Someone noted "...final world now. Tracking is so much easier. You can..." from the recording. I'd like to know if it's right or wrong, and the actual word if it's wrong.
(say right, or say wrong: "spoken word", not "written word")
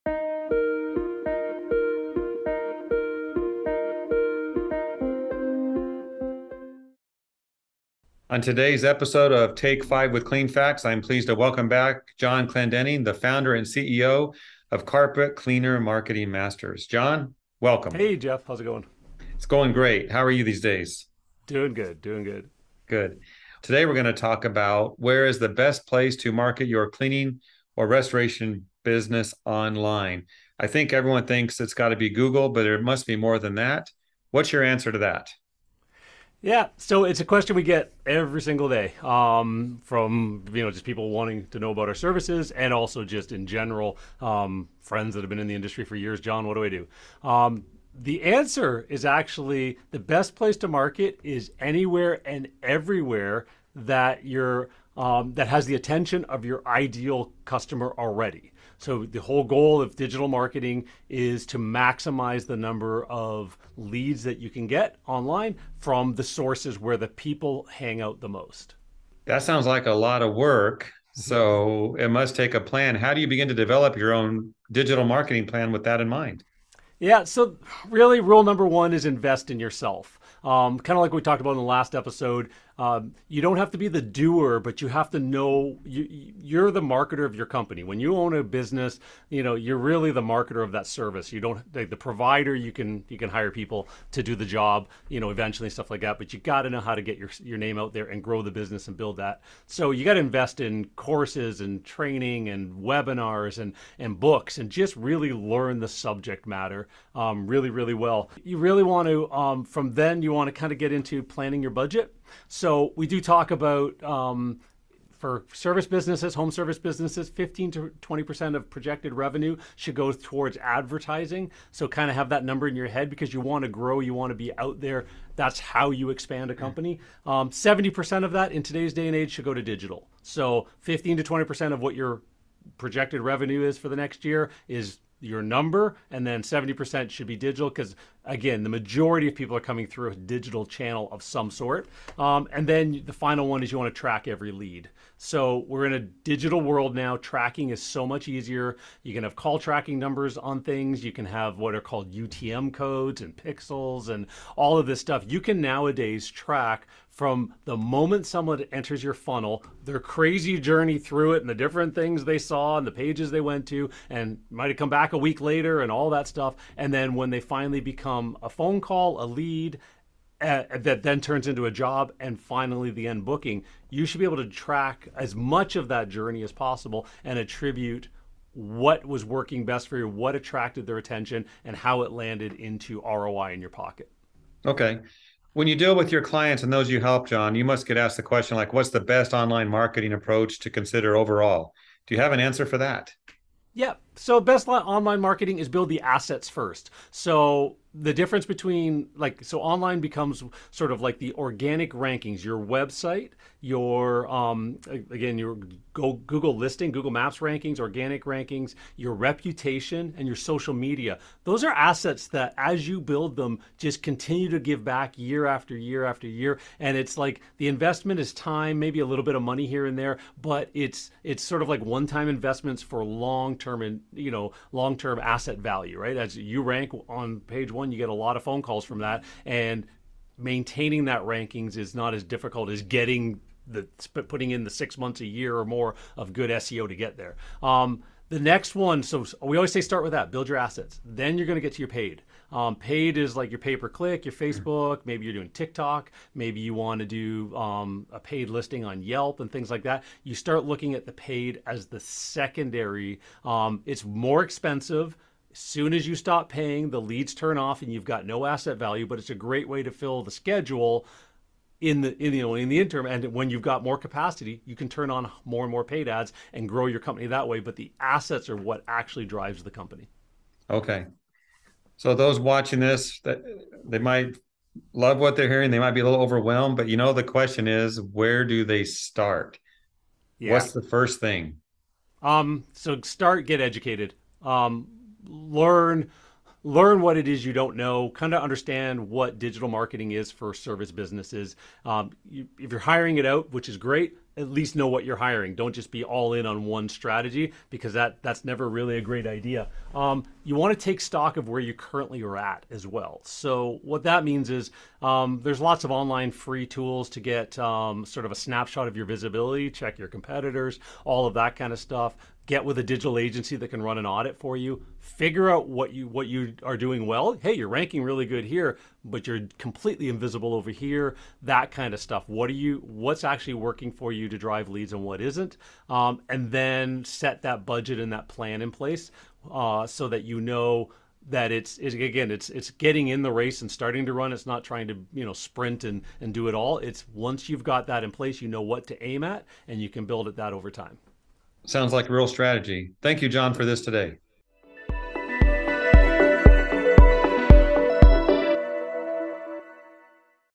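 wrong: "digital", not "final".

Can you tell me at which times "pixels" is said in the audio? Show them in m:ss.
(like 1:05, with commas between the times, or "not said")
2:33.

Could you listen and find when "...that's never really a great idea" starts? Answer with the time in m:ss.
4:58.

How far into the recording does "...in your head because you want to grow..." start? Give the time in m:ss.
2:02.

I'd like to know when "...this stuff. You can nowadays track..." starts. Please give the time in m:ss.
2:34.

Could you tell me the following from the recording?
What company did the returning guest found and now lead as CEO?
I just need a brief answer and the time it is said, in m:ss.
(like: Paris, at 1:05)
Carpet Cleaner Marketing Masters, at 0:14.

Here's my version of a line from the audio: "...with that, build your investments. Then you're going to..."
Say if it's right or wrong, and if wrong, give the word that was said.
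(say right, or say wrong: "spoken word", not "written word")
wrong: "assets", not "investments".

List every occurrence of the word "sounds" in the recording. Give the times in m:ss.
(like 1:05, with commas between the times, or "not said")
1:09, 5:41.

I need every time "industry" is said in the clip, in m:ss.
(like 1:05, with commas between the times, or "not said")
0:45.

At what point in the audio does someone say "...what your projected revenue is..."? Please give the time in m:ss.
2:11.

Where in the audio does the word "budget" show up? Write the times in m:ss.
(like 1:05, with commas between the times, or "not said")
1:51, 5:27.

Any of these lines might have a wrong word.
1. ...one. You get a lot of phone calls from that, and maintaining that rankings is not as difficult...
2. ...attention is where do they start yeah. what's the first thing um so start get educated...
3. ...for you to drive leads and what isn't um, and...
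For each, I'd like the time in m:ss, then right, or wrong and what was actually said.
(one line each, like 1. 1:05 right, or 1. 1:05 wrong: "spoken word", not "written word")
1. 3:47 right
2. 4:37 wrong: "question", not "attention"
3. 5:23 right.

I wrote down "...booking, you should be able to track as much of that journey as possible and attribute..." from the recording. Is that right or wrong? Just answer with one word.
right.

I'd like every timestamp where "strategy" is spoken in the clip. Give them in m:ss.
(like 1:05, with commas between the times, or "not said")
4:56, 5:42.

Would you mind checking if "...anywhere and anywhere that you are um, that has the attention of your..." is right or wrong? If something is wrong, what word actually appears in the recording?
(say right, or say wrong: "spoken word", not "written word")
wrong: "everywhere", not "anywhere".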